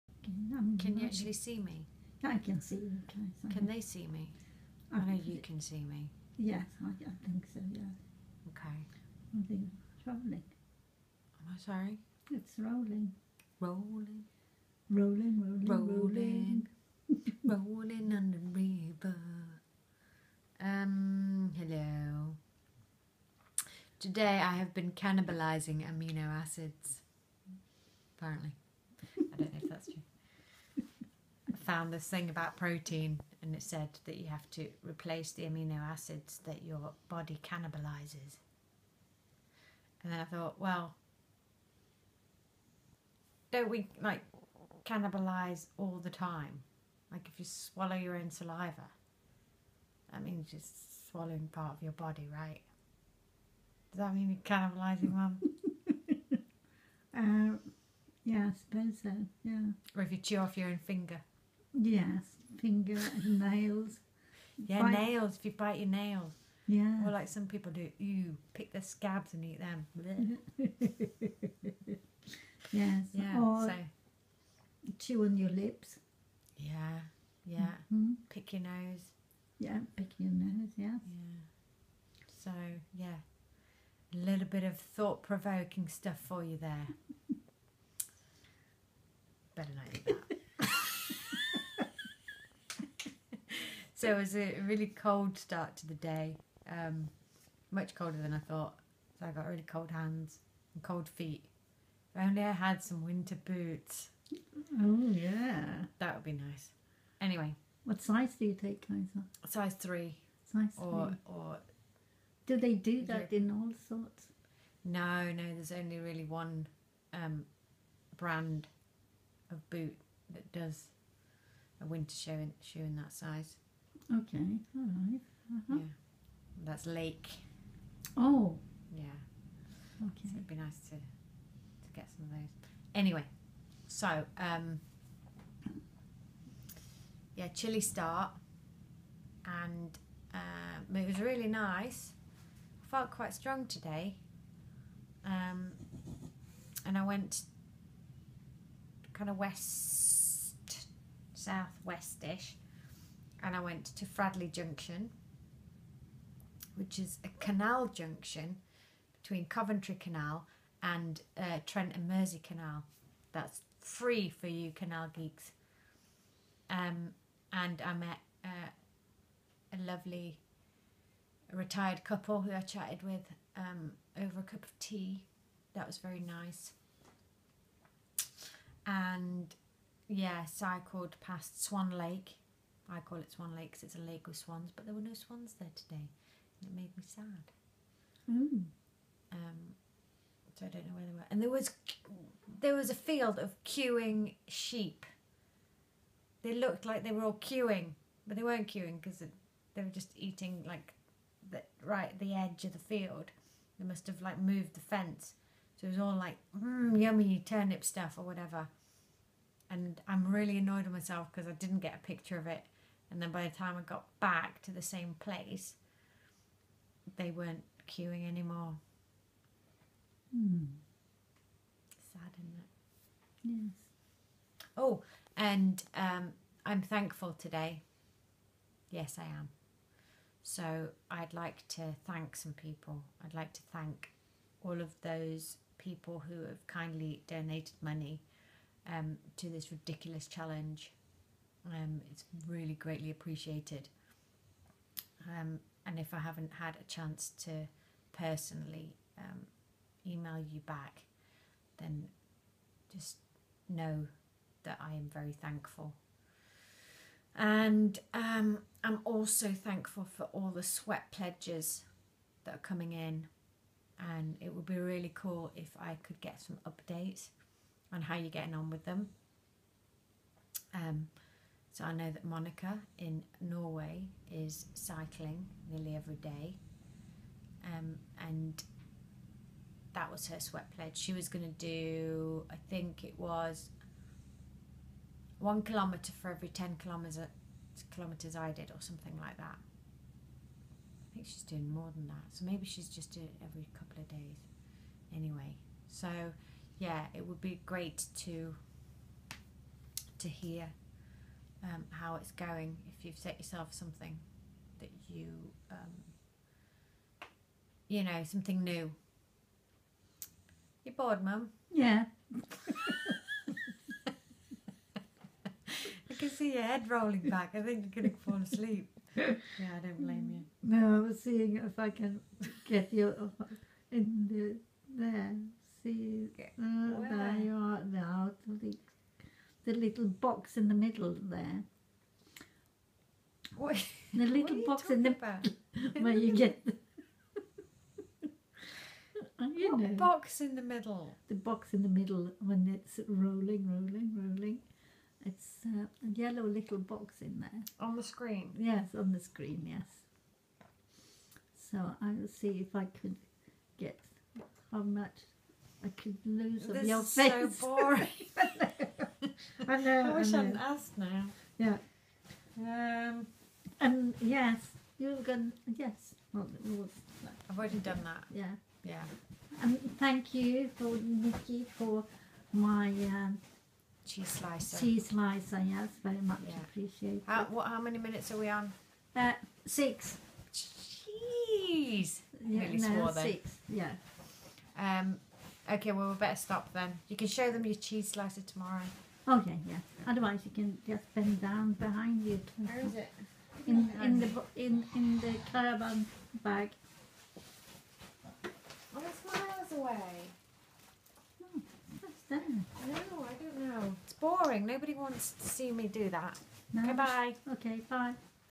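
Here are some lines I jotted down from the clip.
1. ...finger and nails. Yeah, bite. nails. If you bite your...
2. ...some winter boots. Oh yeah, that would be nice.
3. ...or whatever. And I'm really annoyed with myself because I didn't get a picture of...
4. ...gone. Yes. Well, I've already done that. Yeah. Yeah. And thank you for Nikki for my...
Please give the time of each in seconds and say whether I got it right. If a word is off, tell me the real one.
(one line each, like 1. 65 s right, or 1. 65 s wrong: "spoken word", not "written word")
1. 62 s right
2. 102 s right
3. 208 s right
4. 365 s right.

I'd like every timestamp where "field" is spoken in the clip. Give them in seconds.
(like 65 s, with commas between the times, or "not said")
192 s, 202 s.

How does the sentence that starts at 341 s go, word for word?
The box in the middle when it's rolling, rolling, rolling.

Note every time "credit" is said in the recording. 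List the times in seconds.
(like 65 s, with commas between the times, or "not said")
not said.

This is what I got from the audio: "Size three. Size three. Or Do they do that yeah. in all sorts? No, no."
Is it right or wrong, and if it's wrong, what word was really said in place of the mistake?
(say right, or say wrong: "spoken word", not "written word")
right.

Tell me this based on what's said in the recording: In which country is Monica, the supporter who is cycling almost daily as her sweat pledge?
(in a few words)
Norway.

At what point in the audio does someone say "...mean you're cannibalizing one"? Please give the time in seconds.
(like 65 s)
54 s.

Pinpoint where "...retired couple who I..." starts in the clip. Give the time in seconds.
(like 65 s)
171 s.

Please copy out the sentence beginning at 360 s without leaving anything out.
I wish I hadn't asked now.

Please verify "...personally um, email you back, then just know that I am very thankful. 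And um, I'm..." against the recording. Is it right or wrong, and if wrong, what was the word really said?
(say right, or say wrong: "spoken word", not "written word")
right.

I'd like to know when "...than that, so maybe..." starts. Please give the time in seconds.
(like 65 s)
291 s.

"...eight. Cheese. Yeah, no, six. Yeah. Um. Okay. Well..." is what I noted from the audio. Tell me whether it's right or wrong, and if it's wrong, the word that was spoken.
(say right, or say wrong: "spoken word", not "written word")
wrong: "six", not "eight".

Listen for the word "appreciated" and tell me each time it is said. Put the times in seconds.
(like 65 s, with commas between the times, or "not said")
243 s, 376 s.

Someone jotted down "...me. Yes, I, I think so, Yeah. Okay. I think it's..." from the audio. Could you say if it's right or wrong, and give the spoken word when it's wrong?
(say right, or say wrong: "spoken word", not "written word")
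right.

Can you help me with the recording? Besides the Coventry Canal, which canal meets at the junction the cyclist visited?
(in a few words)
Trent and Mersey Canal.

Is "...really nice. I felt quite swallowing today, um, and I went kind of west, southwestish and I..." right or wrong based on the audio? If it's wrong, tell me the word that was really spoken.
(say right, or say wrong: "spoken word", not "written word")
wrong: "strong", not "swallowing".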